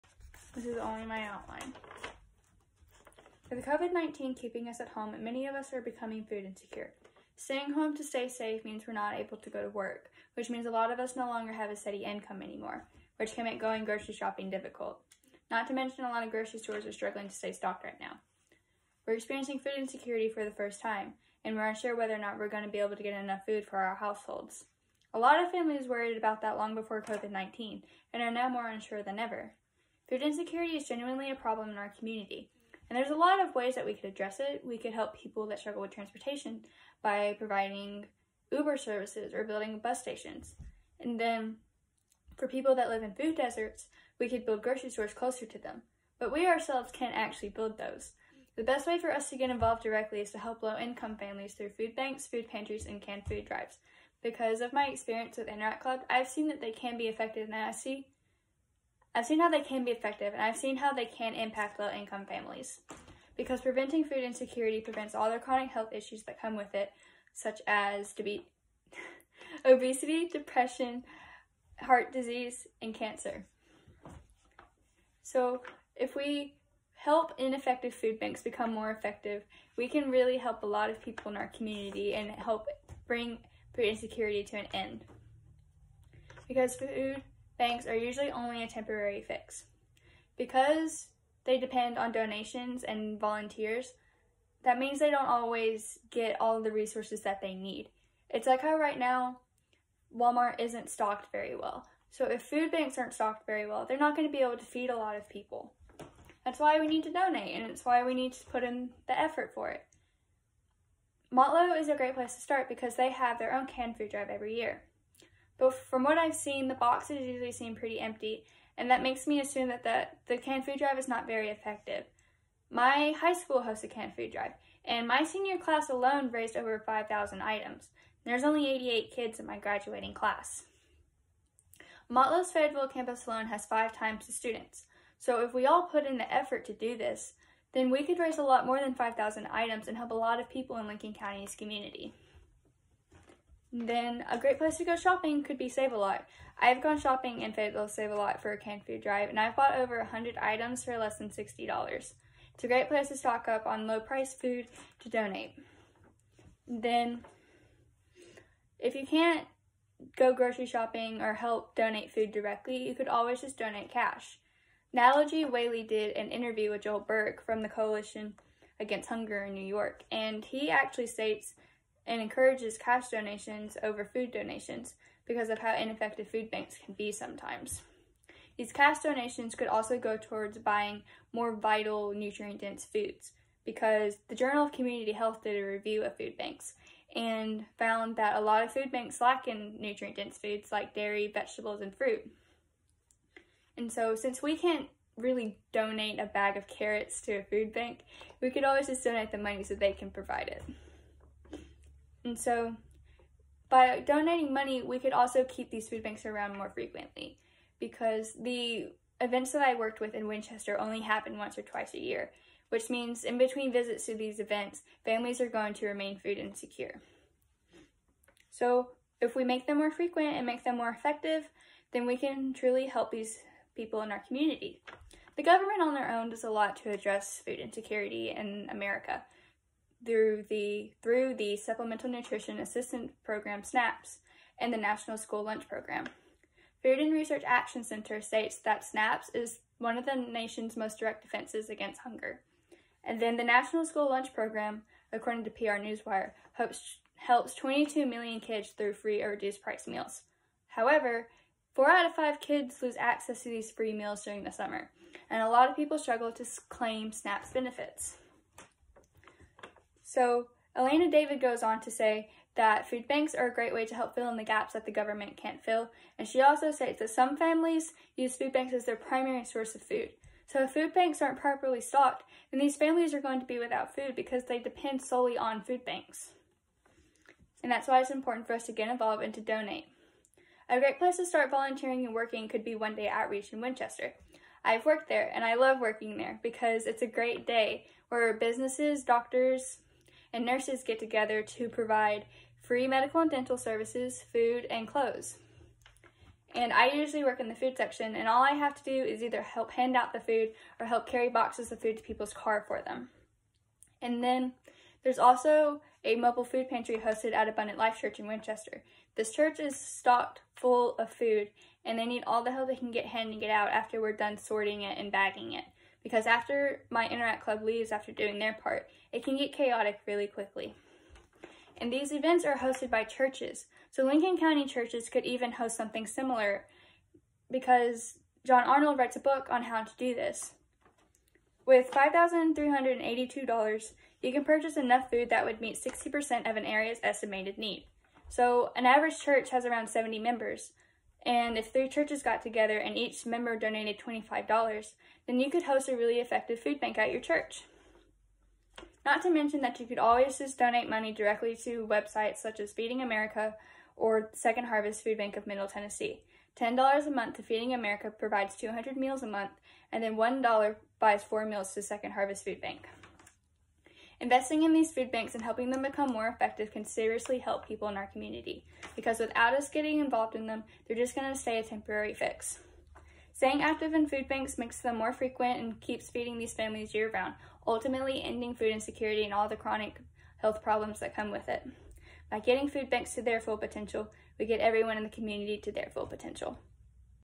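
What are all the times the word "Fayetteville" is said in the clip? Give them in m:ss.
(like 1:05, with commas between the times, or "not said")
2:12, 2:27.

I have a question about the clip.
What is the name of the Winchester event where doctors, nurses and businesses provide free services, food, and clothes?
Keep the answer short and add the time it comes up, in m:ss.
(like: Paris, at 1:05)
One Day Outreach, at 4:42.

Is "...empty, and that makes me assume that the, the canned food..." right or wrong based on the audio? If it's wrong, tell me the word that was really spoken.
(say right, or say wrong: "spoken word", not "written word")
right.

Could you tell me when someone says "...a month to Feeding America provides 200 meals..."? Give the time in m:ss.
5:57.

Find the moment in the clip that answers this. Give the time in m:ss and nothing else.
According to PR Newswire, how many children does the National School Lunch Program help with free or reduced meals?
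4:07.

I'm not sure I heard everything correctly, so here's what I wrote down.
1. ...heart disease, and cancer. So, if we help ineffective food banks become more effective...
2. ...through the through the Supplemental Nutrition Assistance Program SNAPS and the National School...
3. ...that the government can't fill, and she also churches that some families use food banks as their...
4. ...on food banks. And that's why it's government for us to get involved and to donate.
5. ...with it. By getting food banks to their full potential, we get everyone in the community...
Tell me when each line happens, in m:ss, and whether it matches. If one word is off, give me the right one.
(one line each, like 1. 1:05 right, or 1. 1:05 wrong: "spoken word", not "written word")
1. 1:11 right
2. 3:50 right
3. 4:24 wrong: "states", not "churches"
4. 4:35 wrong: "important", not "government"
5. 6:21 right.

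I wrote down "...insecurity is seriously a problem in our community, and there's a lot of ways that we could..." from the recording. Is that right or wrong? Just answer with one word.
wrong.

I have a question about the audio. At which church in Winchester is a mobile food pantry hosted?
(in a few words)
Abundant Life Church.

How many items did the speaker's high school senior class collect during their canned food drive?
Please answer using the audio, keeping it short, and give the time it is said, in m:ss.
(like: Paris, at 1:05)
over 5,000, at 2:06.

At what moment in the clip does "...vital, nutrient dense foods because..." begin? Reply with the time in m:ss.
3:01.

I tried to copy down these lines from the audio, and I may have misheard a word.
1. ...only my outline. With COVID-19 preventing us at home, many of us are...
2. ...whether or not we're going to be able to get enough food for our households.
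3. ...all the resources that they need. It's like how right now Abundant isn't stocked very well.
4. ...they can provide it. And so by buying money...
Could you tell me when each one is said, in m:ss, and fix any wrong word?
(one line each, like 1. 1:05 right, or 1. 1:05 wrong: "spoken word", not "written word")
1. 0:00 wrong: "keeping", not "preventing"
2. 0:21 right
3. 1:36 wrong: "Walmart", not "Abundant"
4. 3:19 wrong: "donating", not "buying".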